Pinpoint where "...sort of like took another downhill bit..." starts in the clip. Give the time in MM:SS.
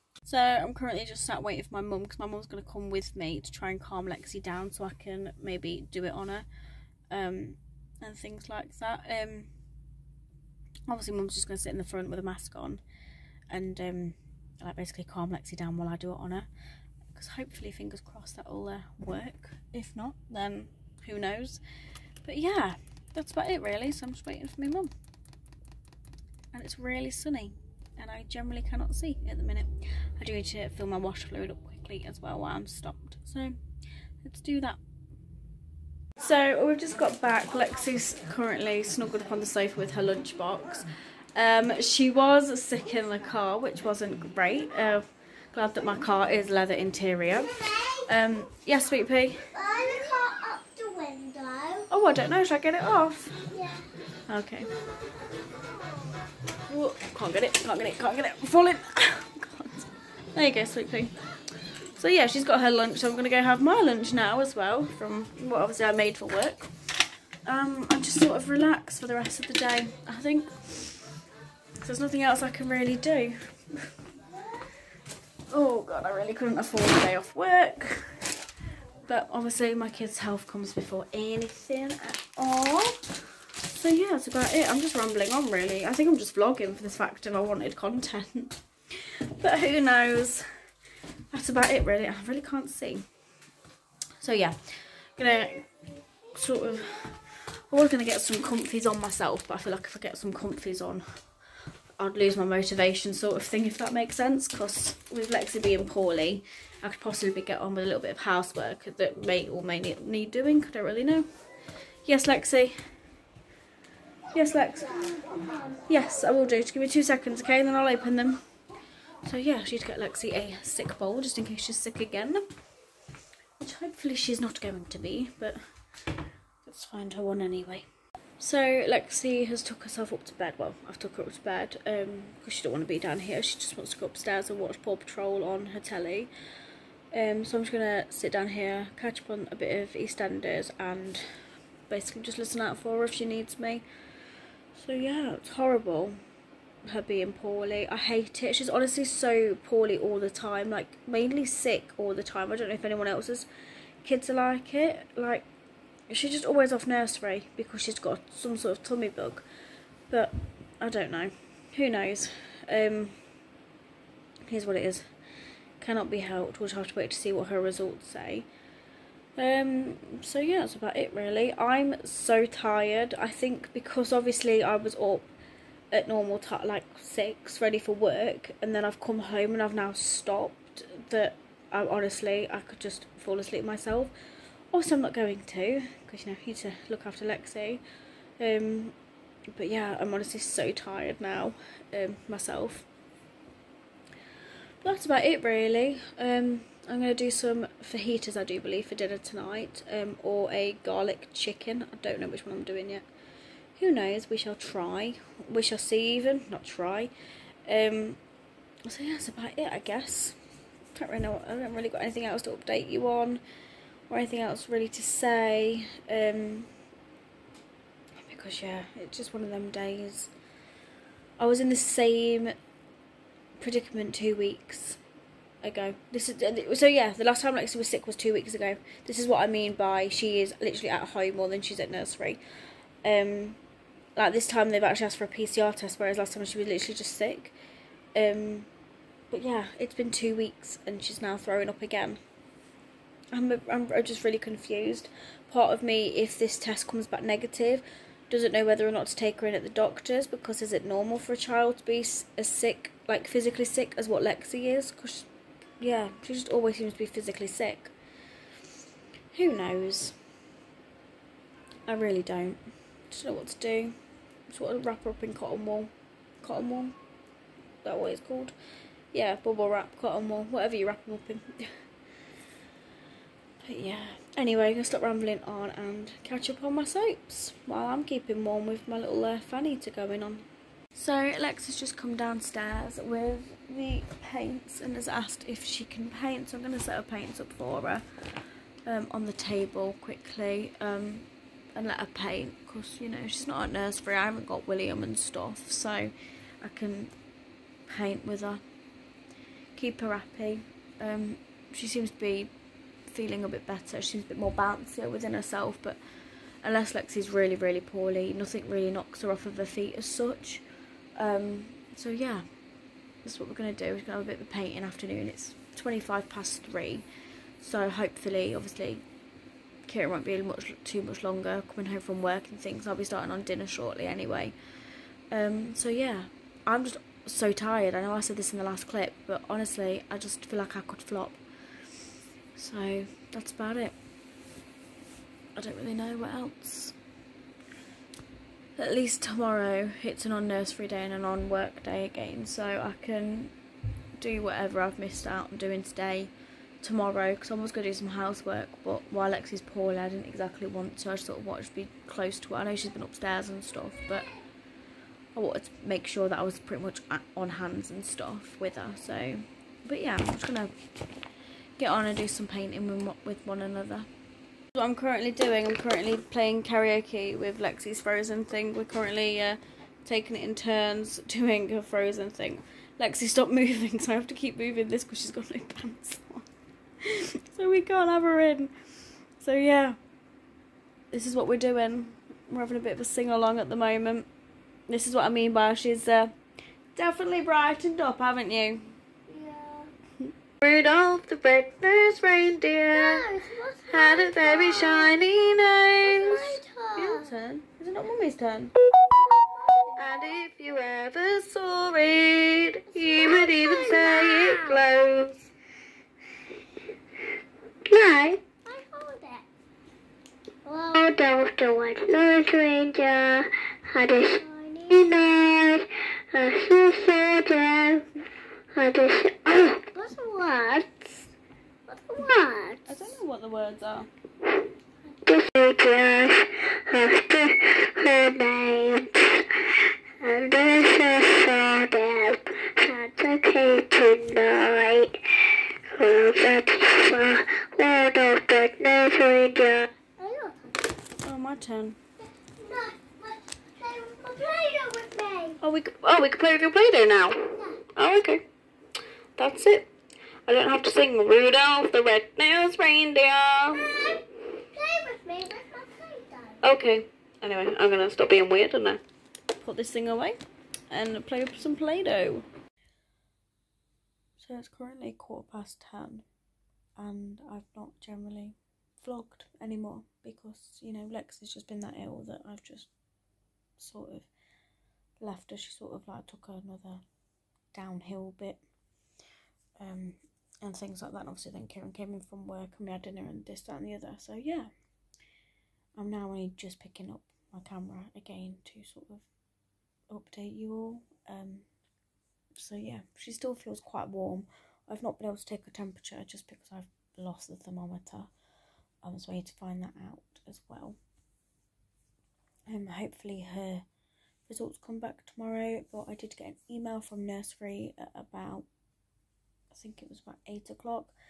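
07:55.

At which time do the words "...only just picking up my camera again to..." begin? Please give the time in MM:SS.
08:06.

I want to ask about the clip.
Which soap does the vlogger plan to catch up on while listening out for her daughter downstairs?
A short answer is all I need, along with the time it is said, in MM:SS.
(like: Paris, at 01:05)
EastEnders, at 02:19.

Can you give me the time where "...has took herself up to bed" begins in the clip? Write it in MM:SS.
02:09.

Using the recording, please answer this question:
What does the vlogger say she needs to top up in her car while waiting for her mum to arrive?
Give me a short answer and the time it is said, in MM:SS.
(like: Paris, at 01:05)
Wash fluid, at 00:30.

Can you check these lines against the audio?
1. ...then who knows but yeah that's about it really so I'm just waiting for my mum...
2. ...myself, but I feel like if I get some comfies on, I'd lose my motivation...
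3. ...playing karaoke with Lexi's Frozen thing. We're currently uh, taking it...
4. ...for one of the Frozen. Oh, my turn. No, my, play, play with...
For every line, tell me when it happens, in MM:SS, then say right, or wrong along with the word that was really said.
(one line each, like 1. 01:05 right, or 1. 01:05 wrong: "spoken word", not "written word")
1. 00:20 right
2. 01:38 right
3. 06:06 right
4. 07:16 wrong: "Neverina", not "Frozen".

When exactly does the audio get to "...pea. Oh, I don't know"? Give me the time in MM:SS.
00:49.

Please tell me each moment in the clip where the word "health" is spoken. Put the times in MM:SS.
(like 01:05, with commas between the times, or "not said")
01:20.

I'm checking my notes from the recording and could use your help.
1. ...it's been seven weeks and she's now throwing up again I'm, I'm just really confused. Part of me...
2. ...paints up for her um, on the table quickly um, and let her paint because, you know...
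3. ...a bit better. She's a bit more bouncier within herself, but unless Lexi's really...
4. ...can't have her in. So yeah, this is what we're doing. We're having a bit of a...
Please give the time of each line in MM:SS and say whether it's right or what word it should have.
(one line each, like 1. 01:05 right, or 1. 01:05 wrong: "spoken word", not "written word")
1. 03:59 wrong: "two", not "seven"
2. 04:47 right
3. 05:03 right
4. 06:17 right.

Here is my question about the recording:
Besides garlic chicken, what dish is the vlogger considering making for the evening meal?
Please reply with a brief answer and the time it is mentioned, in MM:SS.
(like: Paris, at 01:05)
Fajitas, at 03:17.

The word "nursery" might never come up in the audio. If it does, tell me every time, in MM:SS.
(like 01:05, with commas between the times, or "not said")
02:36, 03:51, 04:53, 05:40, 08:27.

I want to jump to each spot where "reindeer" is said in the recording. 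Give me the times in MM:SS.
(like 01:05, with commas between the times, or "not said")
06:32, 06:52, 07:32.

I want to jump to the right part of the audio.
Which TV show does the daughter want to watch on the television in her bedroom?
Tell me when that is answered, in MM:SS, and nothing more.
02:14.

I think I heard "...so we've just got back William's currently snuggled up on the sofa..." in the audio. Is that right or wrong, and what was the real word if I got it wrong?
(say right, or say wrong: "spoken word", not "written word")
wrong: "Lexi", not "William".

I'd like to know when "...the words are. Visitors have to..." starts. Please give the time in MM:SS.
07:03.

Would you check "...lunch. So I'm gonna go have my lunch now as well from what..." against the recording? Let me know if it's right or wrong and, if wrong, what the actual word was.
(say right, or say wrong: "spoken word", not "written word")
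right.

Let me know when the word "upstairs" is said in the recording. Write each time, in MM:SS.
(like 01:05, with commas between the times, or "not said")
02:14, 05:53.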